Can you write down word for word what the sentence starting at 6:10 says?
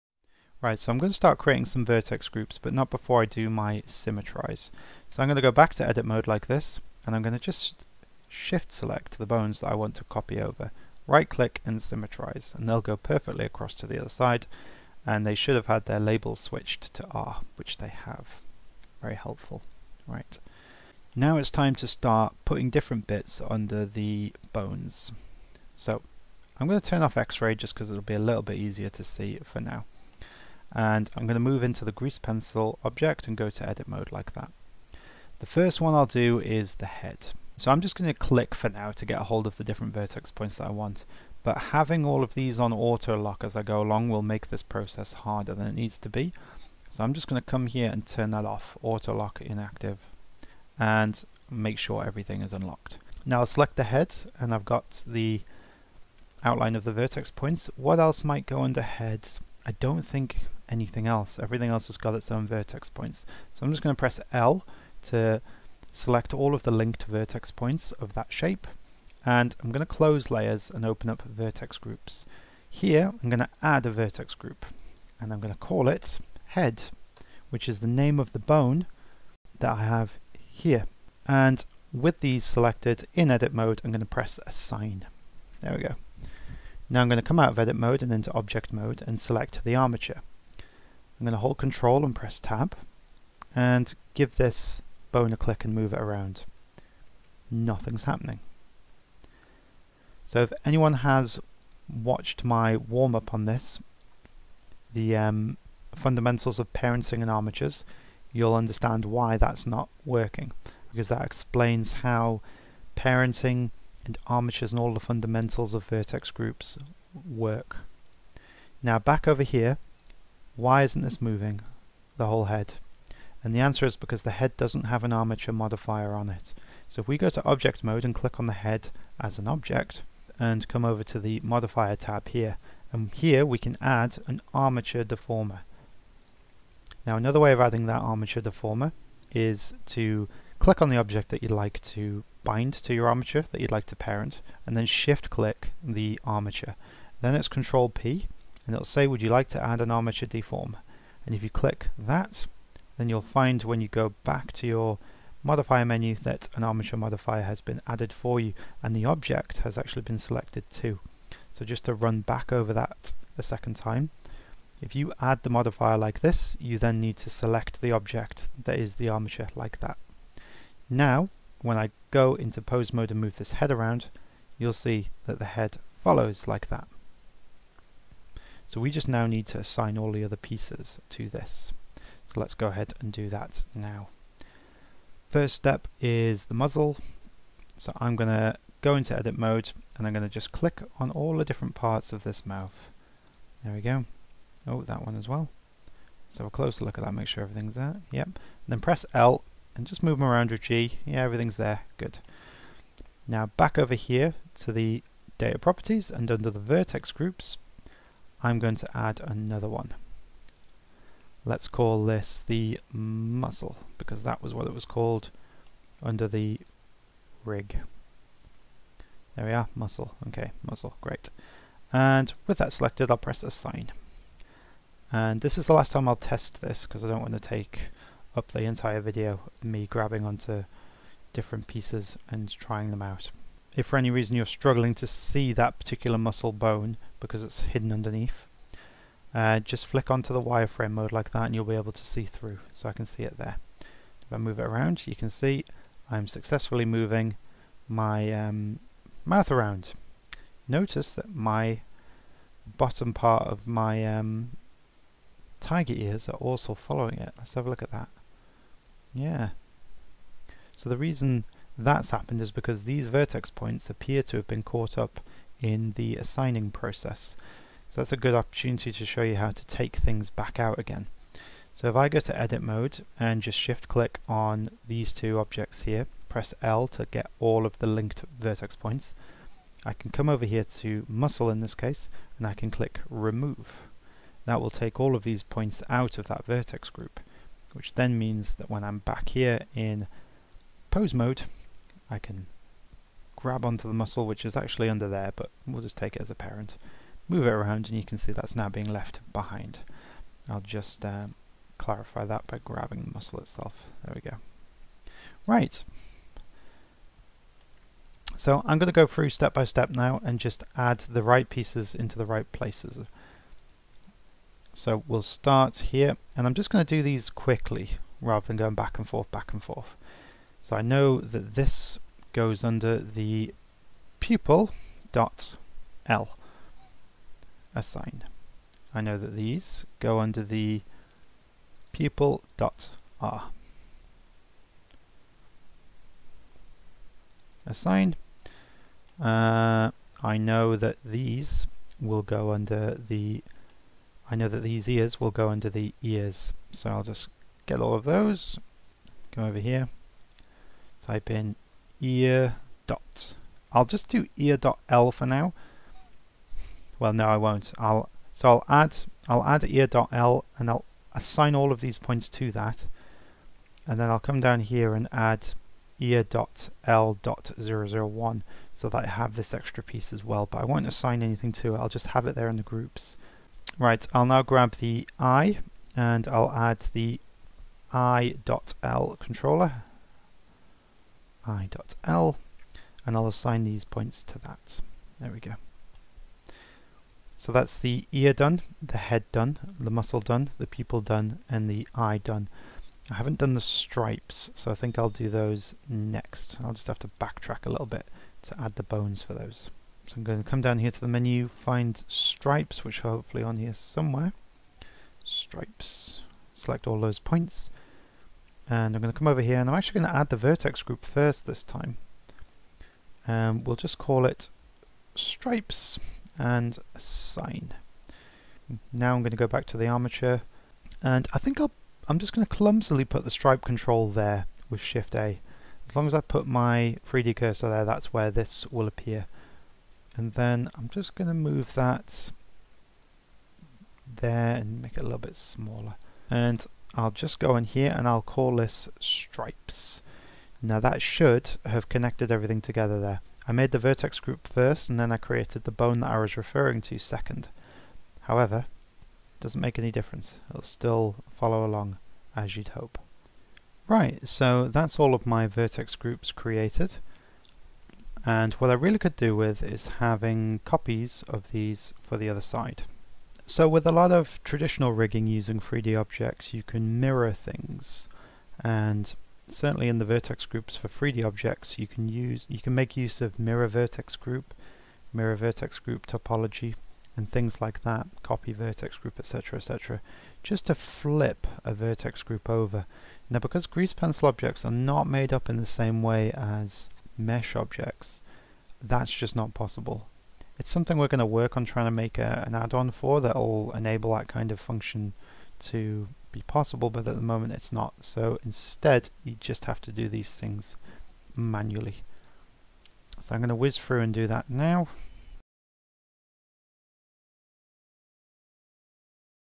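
But I won't assign anything to it.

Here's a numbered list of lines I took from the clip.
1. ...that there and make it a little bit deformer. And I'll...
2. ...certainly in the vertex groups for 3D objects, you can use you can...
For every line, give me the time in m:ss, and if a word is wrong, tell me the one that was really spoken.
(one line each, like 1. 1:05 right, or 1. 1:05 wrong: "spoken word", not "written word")
1. 7:11 wrong: "smaller", not "deformer"
2. 7:49 right.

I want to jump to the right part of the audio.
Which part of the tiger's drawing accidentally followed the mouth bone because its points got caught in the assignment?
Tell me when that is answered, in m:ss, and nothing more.
4:15.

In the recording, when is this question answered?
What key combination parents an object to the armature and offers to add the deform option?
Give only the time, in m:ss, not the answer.
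2:27.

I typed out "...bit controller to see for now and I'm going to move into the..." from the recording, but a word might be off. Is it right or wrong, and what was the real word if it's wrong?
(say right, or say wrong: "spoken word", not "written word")
wrong: "easier", not "controller".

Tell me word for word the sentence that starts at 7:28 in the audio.
However, it doesn't make any difference.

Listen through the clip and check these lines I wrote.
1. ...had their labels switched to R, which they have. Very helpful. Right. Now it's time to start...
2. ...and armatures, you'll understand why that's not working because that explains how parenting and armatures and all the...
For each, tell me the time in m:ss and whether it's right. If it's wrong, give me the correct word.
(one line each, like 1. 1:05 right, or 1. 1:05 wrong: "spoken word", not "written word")
1. 0:15 right
2. 1:47 right.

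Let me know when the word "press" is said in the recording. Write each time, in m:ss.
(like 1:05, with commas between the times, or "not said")
1:03, 1:24, 1:32, 3:18, 3:43, 4:36.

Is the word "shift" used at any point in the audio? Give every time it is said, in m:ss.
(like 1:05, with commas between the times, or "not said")
0:08, 2:24, 4:33, 7:04.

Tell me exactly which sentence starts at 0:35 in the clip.
The first one I'll do is the head.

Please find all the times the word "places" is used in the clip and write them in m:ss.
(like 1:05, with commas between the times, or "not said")
5:12.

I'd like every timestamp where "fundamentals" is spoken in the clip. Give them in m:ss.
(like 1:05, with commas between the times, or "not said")
1:45, 1:54.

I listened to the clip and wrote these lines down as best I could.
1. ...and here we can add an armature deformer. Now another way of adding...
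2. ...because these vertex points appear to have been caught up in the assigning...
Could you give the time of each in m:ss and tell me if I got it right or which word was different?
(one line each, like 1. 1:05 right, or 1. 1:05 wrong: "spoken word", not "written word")
1. 2:12 right
2. 4:22 right.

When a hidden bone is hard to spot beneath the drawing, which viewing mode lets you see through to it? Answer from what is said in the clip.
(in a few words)
Wireframe mode.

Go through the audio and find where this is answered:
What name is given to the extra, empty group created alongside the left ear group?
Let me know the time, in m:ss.
6:05.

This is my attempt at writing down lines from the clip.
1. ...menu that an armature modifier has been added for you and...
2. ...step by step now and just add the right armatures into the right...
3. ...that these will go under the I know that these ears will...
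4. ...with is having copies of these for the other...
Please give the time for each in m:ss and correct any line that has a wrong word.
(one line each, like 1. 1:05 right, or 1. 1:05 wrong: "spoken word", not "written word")
1. 2:35 right
2. 5:09 wrong: "pieces", not "armatures"
3. 5:40 right
4. 7:39 right.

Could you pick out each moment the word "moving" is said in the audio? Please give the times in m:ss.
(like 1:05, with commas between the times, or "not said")
2:01, 4:06.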